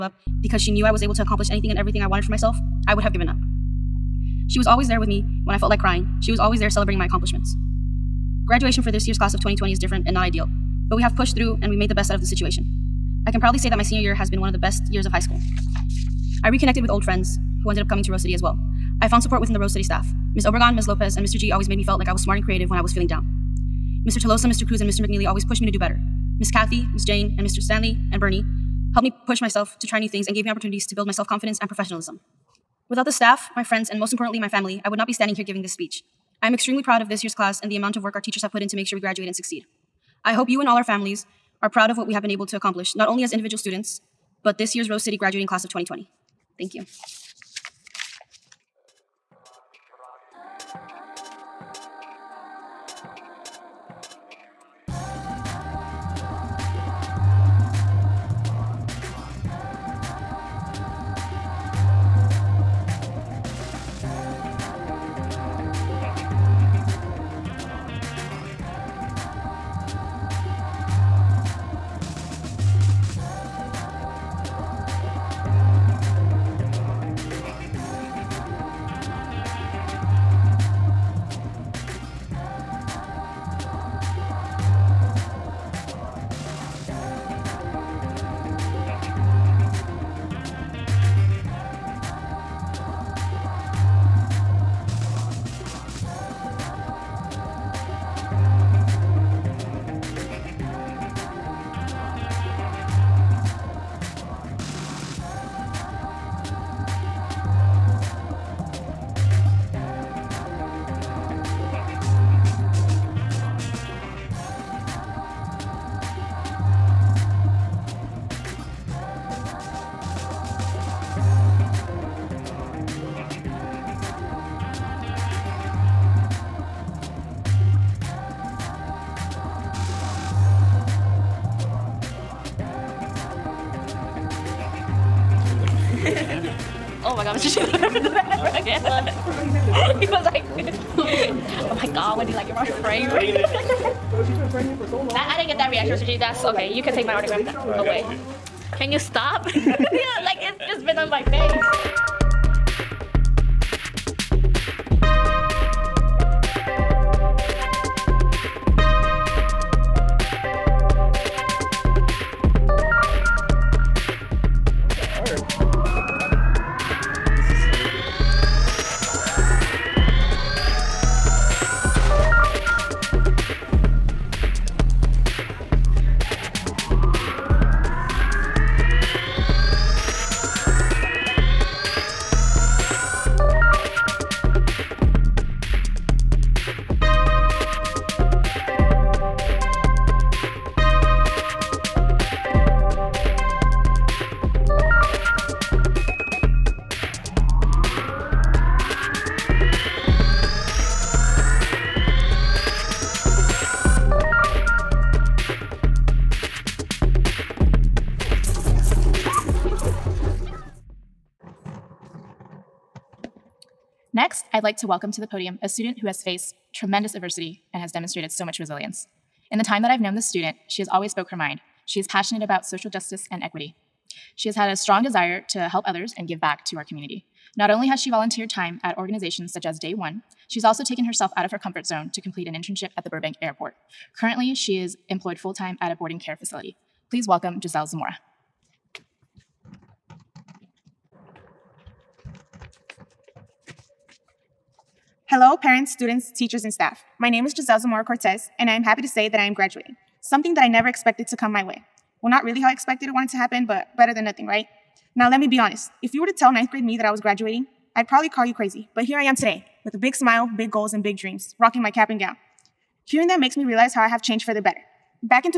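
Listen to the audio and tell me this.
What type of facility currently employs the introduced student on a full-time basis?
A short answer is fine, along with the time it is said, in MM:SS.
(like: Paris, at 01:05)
boarding care facility, at 03:55.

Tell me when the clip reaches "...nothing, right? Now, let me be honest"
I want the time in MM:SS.
04:14.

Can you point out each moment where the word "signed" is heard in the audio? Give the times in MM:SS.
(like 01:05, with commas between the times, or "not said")
not said.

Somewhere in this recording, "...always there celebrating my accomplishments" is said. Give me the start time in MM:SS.
00:06.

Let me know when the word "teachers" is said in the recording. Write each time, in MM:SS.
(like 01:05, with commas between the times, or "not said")
00:38, 04:06.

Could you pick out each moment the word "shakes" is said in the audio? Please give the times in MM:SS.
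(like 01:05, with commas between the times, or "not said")
not said.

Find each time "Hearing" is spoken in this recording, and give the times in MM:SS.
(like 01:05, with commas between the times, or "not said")
04:23.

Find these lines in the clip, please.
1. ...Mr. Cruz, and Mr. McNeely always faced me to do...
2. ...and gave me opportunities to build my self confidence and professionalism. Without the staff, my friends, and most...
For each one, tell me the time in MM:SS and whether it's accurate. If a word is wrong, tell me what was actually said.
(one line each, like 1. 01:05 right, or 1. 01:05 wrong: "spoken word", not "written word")
1. 00:24 wrong: "pushed", not "faced"
2. 00:30 right.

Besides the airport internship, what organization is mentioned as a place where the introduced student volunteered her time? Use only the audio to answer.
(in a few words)
Day One.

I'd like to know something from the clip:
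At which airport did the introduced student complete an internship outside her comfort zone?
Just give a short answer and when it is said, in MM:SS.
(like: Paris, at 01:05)
Burbank Airport, at 03:53.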